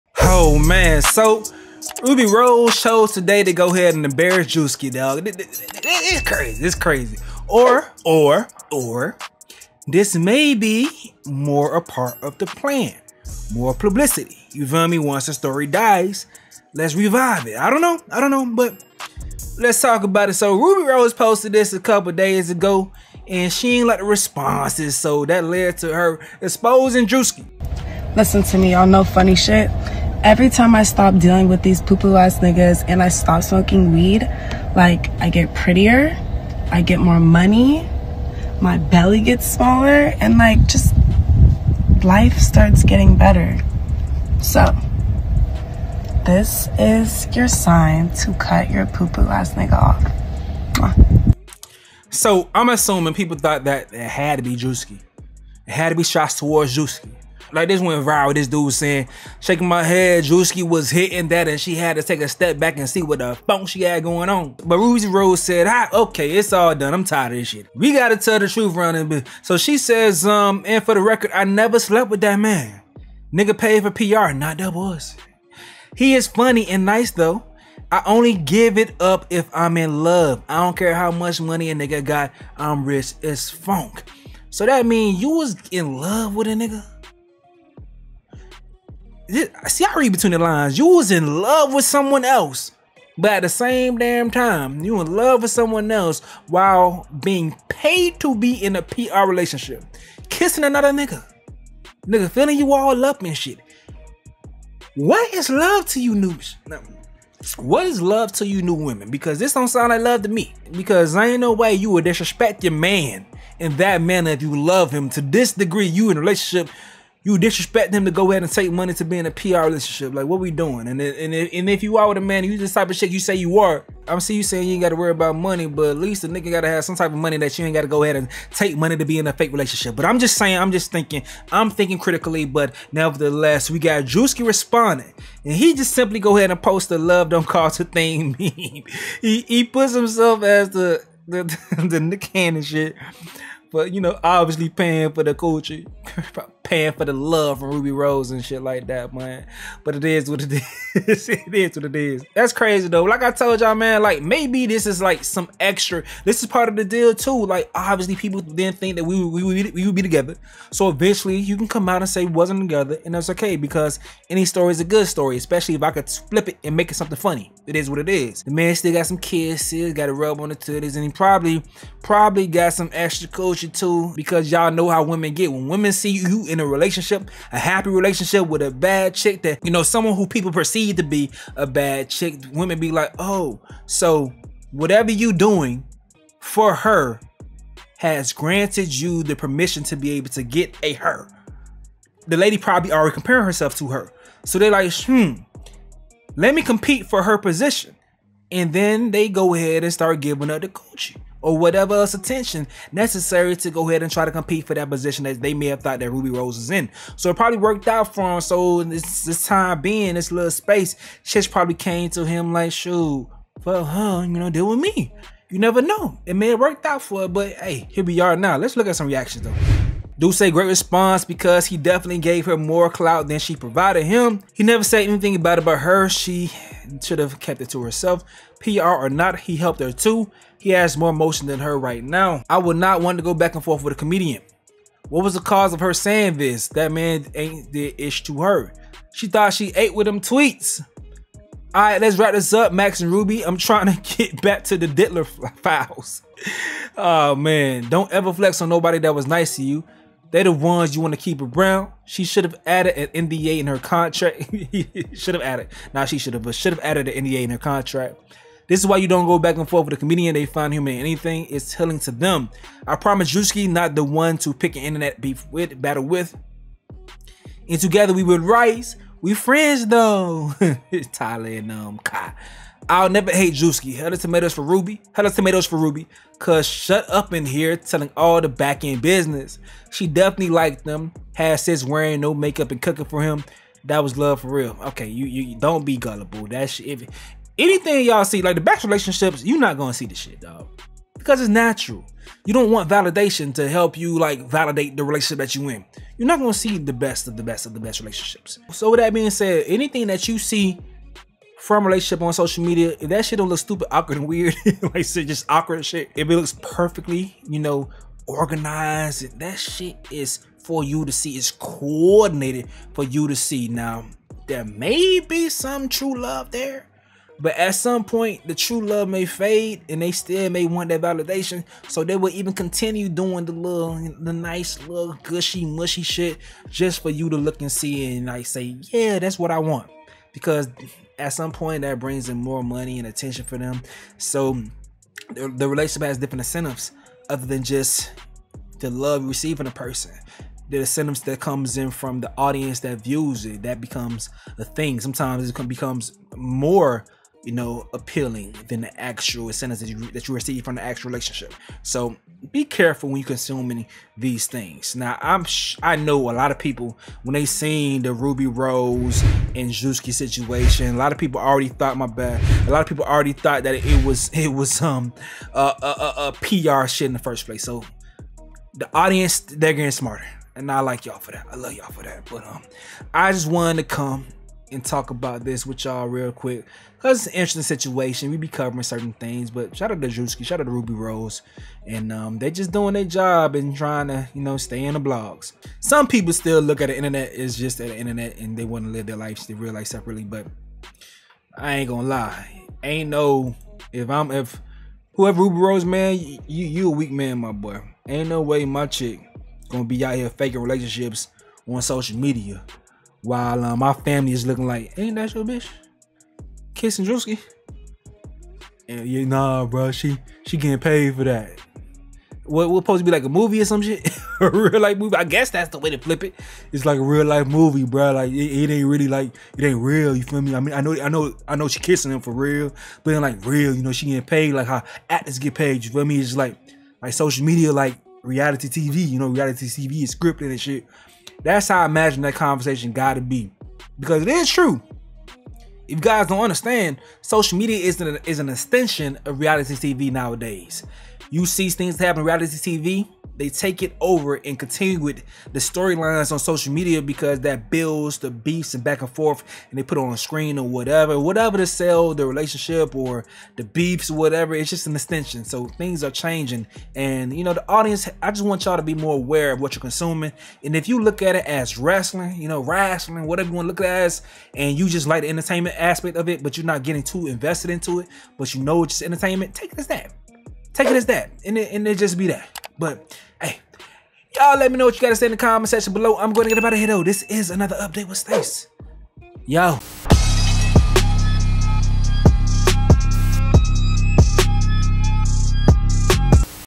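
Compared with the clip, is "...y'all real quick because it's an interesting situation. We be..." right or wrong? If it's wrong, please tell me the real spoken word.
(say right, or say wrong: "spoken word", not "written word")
right.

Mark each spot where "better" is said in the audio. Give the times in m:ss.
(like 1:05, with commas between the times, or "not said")
0:43.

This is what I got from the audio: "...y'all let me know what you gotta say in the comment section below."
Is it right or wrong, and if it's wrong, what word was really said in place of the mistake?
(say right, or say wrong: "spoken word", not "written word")
right.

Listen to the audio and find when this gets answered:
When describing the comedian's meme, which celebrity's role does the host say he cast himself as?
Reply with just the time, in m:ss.
2:21.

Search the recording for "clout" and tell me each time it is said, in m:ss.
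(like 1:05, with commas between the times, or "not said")
3:42.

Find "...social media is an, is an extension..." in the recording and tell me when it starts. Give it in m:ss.
7:17.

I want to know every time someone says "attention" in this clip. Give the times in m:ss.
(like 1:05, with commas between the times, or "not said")
3:22, 5:33.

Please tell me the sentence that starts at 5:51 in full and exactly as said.
So be careful when you consuming these things.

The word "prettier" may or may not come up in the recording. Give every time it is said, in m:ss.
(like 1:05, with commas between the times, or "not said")
0:35.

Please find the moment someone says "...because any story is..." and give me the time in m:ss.
2:43.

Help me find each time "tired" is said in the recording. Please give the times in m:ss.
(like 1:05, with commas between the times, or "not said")
1:07.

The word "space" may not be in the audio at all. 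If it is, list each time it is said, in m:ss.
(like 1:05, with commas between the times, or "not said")
3:30.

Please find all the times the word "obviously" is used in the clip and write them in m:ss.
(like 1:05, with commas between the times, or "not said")
2:24, 2:37.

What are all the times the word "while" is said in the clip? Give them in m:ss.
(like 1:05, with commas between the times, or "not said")
1:36, 6:43.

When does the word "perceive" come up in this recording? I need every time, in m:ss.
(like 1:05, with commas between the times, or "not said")
3:00.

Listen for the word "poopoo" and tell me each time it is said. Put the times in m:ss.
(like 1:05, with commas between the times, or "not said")
0:31, 0:48.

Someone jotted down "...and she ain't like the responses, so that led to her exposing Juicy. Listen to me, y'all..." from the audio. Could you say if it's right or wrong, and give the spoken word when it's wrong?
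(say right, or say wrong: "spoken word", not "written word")
right.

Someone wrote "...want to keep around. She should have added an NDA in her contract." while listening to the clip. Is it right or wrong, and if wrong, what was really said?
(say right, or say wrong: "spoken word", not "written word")
right.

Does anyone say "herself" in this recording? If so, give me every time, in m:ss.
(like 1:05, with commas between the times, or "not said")
3:13, 3:47.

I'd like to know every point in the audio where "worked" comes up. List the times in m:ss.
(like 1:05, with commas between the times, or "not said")
3:27, 3:36.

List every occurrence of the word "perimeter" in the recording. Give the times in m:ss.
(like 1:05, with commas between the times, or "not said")
not said.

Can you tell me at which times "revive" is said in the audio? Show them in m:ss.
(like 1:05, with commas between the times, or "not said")
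0:16.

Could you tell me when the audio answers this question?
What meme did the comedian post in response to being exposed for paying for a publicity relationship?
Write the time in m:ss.
2:16.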